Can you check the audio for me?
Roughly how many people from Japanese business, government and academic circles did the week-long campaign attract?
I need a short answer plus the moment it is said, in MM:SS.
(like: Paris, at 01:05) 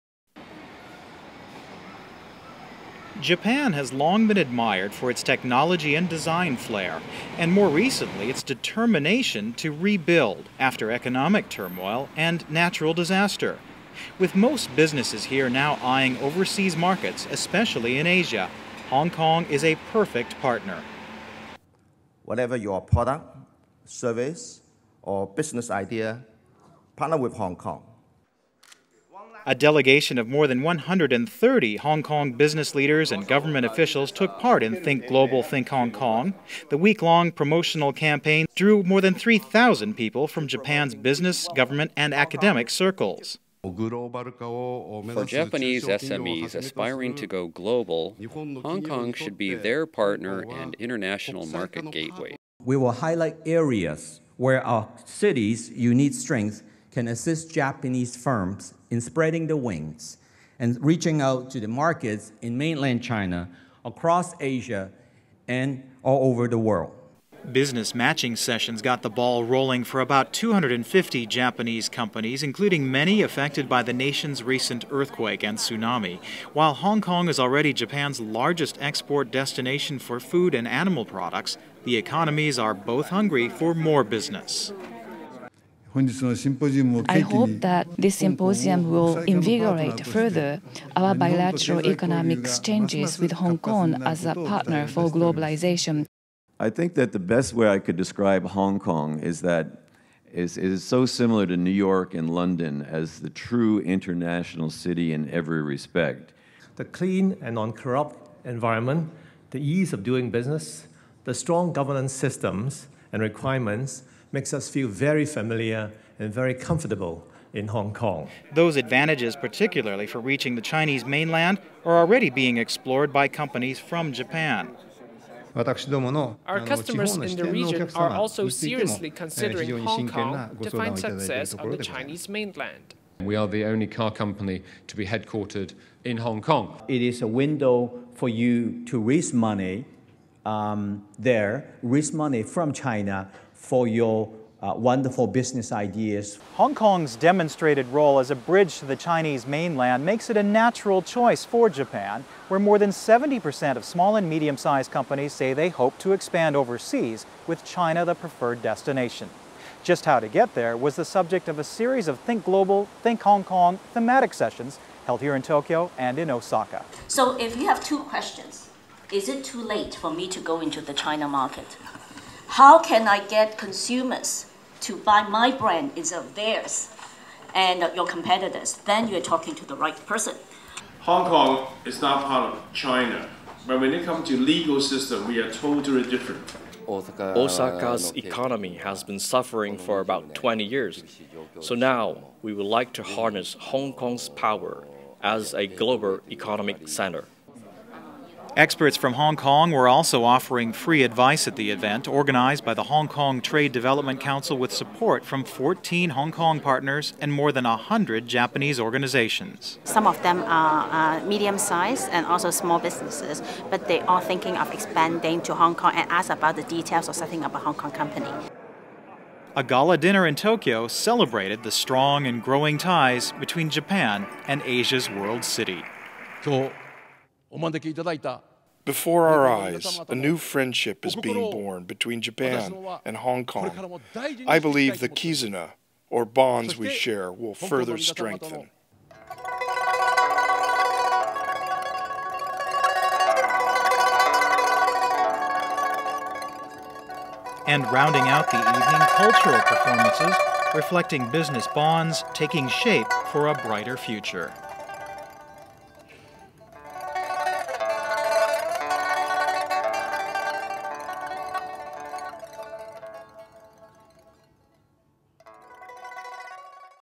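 more than 3,000, at 00:38.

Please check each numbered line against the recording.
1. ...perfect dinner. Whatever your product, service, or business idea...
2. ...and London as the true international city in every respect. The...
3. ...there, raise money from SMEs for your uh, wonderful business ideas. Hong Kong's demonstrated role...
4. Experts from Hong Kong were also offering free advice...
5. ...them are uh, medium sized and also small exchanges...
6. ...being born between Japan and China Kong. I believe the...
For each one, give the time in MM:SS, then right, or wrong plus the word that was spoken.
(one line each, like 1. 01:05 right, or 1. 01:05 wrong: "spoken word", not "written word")
1. 00:19 wrong: "partner", not "dinner"
2. 01:42 right
3. 02:21 wrong: "China", not "SMEs"
4. 03:18 right
5. 03:30 wrong: "businesses", not "exchanges"
6. 03:51 wrong: "Hong", not "China".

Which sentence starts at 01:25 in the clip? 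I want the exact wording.
I hope that this symposium will invigorate further our bilateral economic exchanges with Hong Kong as a partner for globalization.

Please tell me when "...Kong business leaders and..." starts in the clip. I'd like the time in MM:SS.
00:32.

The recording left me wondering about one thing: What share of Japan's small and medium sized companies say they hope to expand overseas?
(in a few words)
more than 70%.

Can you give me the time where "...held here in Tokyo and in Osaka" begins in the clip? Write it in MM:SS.
02:45.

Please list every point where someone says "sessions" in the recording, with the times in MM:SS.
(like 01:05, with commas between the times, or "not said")
01:08, 02:44.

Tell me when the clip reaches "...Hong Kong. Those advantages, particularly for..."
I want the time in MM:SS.
01:57.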